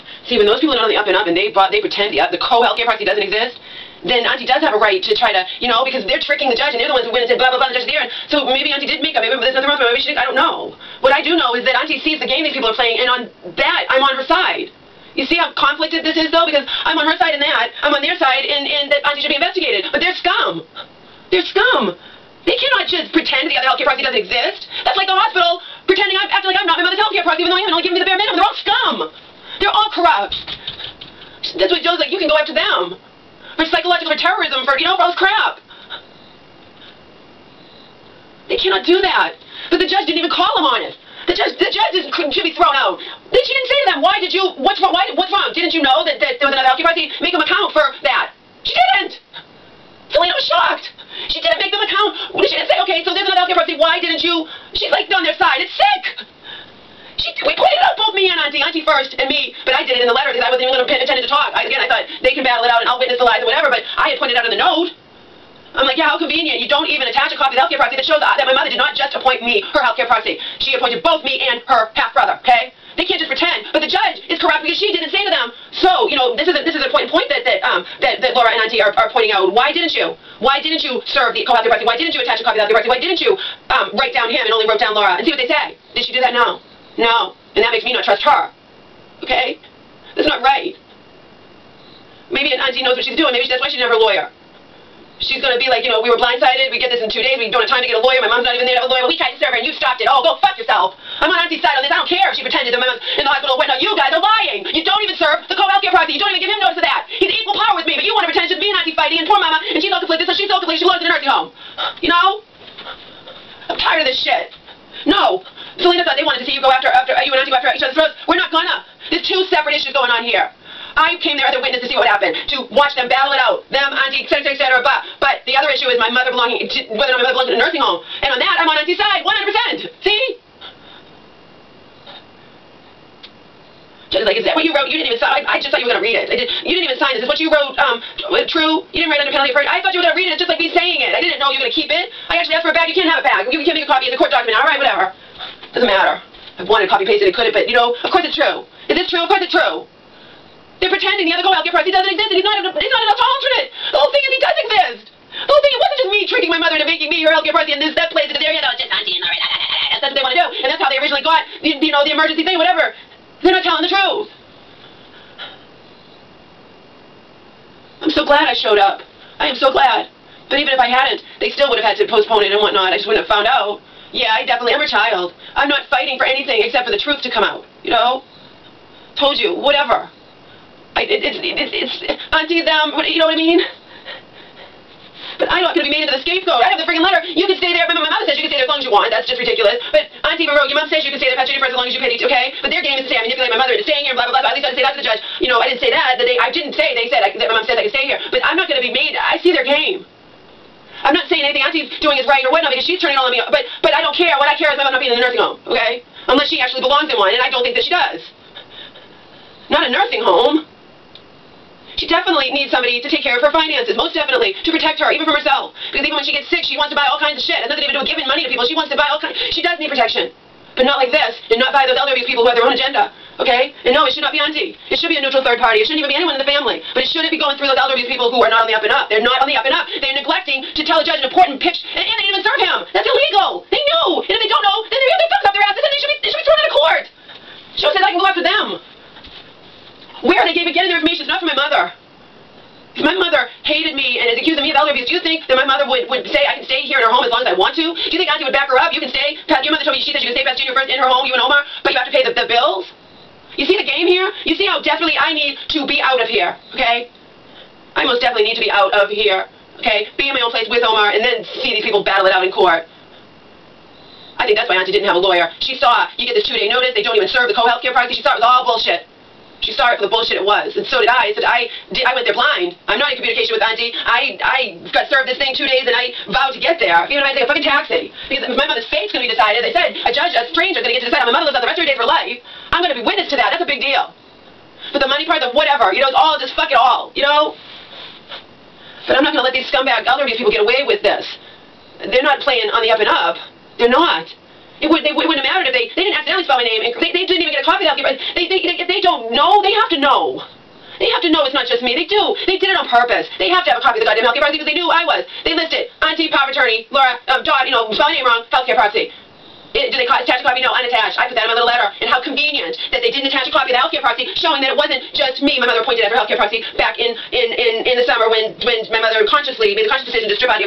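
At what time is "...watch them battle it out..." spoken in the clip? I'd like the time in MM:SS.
02:02.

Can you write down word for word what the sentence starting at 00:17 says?
I'm on their side in, in that Auntie should be investigated.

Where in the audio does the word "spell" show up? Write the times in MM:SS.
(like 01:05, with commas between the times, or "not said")
04:56, 05:07.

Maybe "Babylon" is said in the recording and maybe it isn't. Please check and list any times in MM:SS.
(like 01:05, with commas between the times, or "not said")
not said.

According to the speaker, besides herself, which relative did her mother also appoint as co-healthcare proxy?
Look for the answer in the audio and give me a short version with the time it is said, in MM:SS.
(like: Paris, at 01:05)
Her half-brother, at 01:11.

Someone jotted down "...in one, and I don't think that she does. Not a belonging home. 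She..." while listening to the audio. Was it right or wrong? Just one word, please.
wrong.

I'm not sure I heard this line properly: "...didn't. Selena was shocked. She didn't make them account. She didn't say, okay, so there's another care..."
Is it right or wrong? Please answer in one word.
right.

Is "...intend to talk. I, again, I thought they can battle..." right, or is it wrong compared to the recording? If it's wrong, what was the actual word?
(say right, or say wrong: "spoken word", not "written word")
right.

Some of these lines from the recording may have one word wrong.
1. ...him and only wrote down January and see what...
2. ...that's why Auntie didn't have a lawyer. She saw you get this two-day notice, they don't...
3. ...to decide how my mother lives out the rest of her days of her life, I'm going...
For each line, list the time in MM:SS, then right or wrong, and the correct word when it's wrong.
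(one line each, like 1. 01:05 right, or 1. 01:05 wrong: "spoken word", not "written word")
1. 01:24 wrong: "Laura", not "January"
2. 04:24 right
3. 04:41 right.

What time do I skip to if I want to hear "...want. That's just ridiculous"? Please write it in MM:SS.
03:08.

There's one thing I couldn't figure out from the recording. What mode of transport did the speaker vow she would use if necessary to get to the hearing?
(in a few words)
Taxi.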